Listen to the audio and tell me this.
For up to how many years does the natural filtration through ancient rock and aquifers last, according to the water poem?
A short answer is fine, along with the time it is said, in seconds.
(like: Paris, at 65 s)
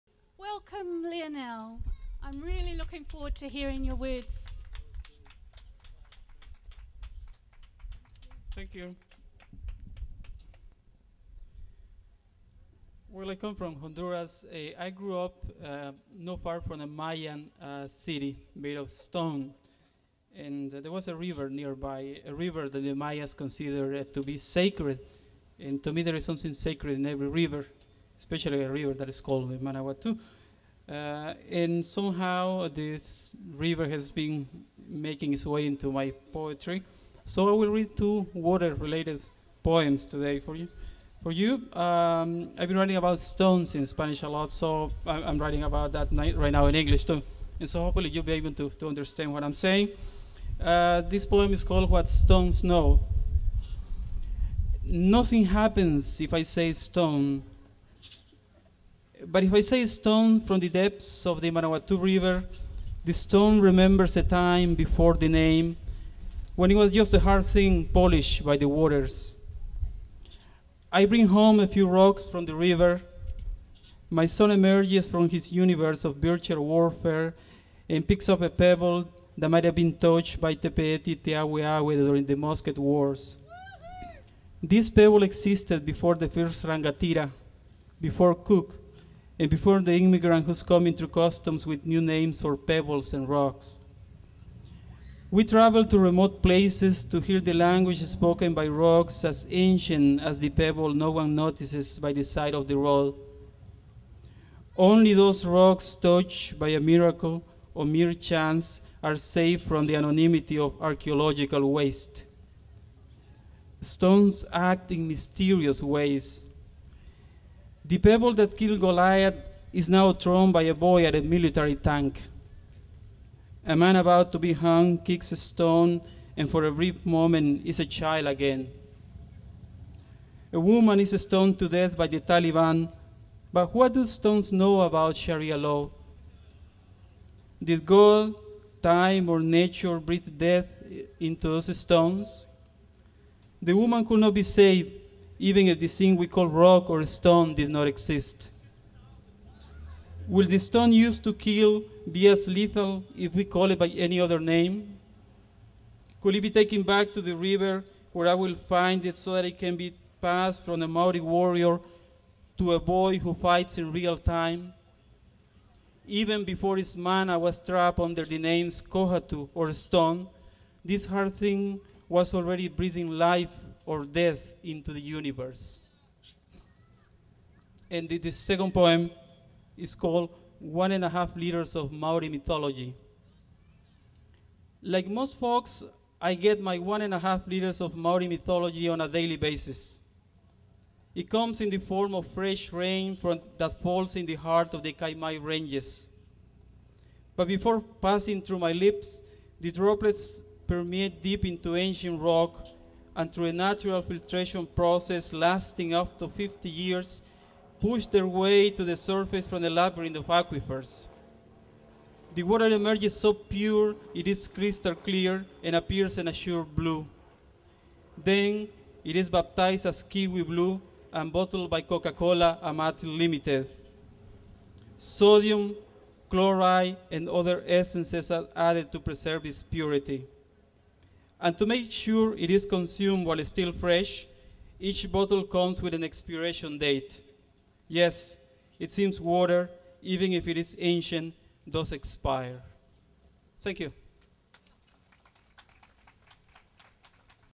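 50 years, at 206 s.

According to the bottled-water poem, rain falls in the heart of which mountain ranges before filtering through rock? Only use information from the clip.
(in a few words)
Kaimai Ranges.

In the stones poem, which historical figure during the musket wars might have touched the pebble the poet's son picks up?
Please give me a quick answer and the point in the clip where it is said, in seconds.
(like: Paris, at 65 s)
Te Peeti Te Awe Awe, at 80 s.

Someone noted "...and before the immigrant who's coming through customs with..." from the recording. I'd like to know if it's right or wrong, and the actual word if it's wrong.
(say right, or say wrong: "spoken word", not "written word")
right.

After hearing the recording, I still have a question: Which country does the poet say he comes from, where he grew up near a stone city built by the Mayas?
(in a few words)
Honduras.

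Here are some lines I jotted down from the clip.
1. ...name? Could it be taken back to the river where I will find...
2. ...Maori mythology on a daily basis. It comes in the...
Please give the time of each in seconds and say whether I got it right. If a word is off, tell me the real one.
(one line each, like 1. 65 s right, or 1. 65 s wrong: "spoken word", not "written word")
1. 154 s right
2. 187 s right.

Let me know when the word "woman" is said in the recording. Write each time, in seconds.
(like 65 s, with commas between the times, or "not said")
130 s, 143 s.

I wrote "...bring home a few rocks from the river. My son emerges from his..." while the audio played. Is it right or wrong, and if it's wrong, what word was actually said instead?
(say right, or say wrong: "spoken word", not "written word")
right.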